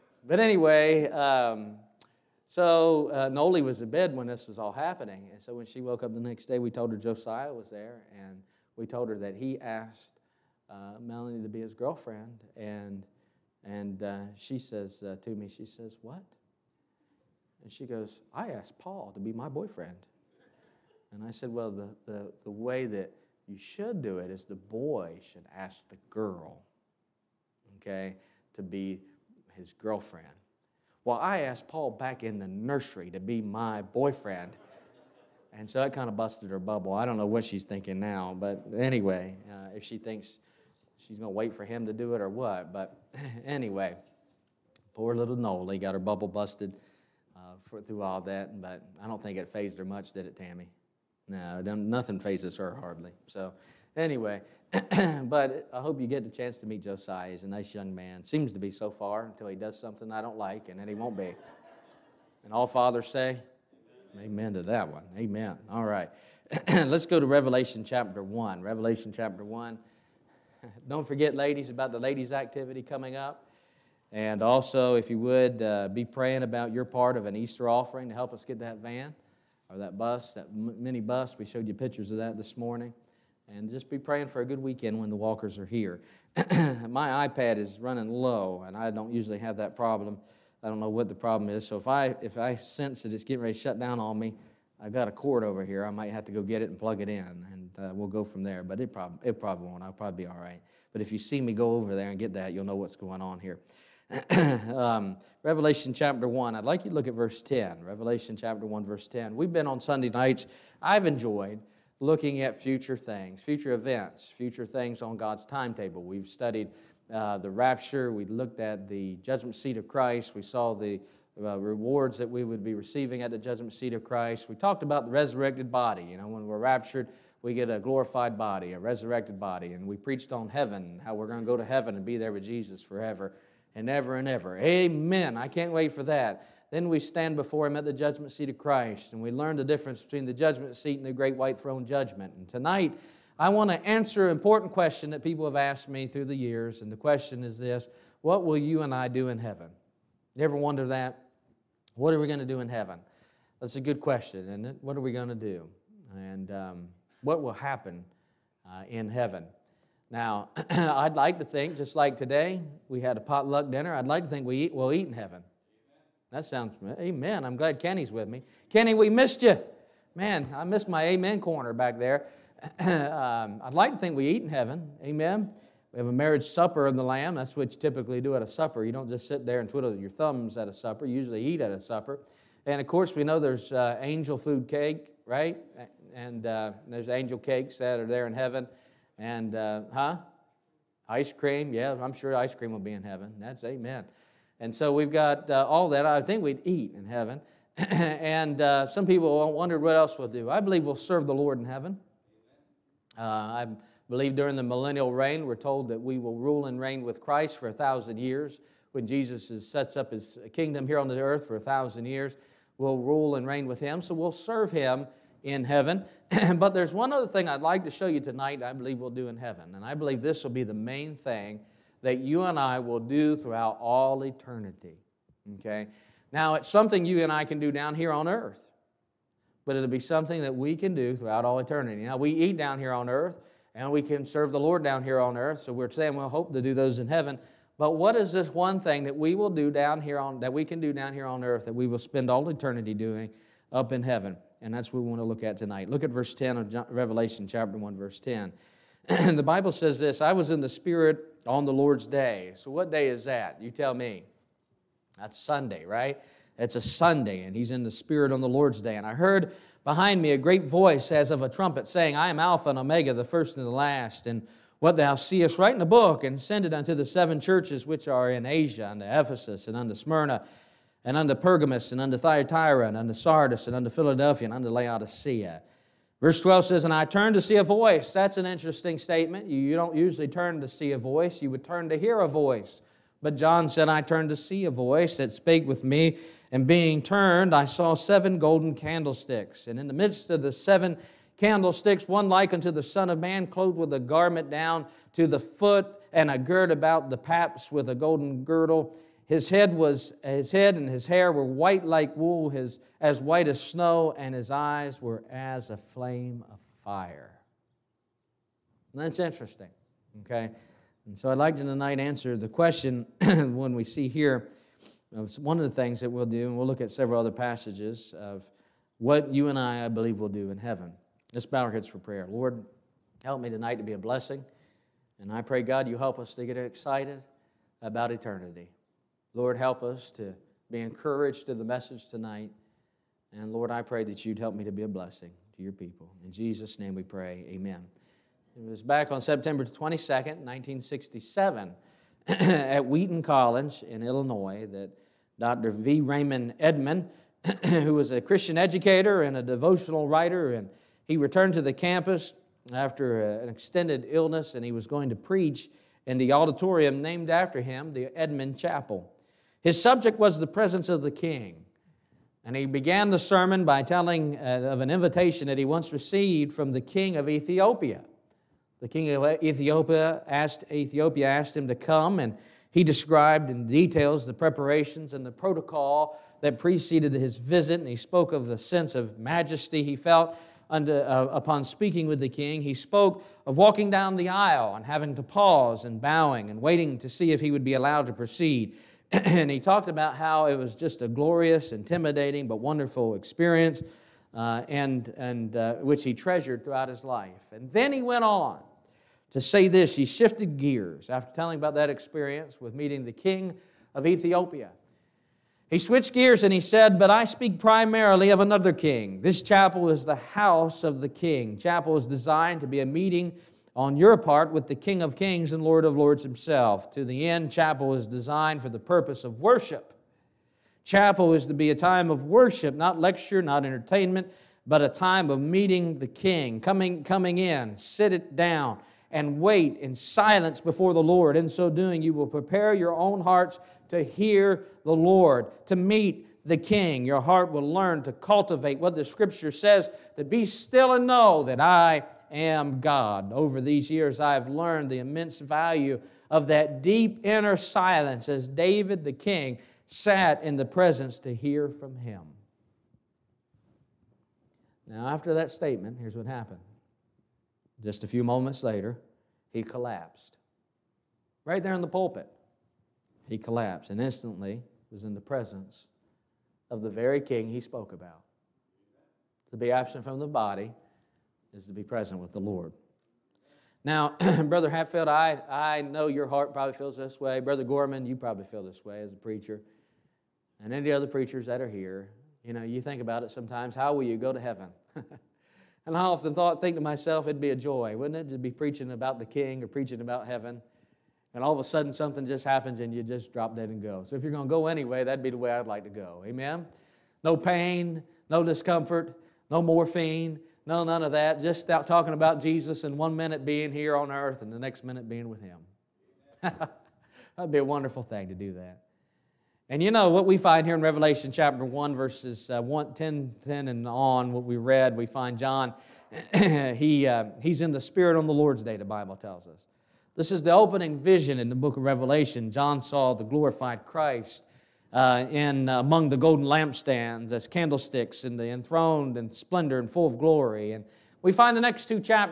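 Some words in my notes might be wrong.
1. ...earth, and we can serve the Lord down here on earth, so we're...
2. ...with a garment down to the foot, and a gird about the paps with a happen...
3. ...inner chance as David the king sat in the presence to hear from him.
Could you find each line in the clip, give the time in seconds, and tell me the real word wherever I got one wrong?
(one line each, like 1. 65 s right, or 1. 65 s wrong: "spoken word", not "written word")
1. 233 s right
2. 293 s wrong: "golden", not "happen"
3. 447 s wrong: "silence", not "chance".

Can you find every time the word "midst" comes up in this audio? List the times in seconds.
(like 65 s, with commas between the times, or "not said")
289 s.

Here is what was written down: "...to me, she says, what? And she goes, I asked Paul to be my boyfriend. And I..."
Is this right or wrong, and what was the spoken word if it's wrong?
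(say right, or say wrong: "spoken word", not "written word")
right.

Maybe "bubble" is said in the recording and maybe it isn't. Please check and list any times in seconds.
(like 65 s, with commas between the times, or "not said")
36 s, 45 s.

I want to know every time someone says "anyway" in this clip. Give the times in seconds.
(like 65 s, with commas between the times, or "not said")
0 s, 38 s, 43 s, 53 s, 494 s.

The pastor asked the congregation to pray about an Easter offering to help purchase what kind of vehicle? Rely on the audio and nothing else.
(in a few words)
mini bus.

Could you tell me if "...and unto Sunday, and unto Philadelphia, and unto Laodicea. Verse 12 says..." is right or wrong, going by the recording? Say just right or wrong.
wrong.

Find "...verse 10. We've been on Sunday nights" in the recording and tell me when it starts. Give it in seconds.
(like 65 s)
108 s.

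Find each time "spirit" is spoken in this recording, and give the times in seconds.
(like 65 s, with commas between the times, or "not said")
250 s, 257 s, 517 s.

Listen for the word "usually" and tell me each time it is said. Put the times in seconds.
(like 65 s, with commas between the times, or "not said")
89 s, 181 s, 279 s.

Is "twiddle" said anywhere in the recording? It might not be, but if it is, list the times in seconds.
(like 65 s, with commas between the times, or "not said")
179 s.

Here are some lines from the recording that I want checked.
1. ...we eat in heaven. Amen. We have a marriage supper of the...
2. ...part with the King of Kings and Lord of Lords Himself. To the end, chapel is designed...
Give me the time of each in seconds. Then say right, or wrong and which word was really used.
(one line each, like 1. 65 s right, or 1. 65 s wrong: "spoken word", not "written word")
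1. 174 s right
2. 414 s right.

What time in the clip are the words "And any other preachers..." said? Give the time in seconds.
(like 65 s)
480 s.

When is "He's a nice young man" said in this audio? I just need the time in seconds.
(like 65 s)
57 s.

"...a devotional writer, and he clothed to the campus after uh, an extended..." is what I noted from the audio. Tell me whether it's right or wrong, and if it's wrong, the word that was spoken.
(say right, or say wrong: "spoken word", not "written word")
wrong: "returned", not "clothed".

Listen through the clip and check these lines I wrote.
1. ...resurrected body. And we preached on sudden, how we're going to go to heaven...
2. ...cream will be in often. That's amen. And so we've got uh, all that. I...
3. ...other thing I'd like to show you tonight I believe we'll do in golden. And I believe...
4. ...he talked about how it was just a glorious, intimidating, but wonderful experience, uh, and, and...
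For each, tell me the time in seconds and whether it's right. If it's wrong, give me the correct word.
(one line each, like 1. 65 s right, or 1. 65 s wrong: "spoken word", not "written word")
1. 128 s wrong: "heaven", not "sudden"
2. 192 s wrong: "heaven", not "often"
3. 217 s wrong: "heaven", not "golden"
4. 389 s right.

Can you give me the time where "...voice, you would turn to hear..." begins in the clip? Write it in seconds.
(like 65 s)
280 s.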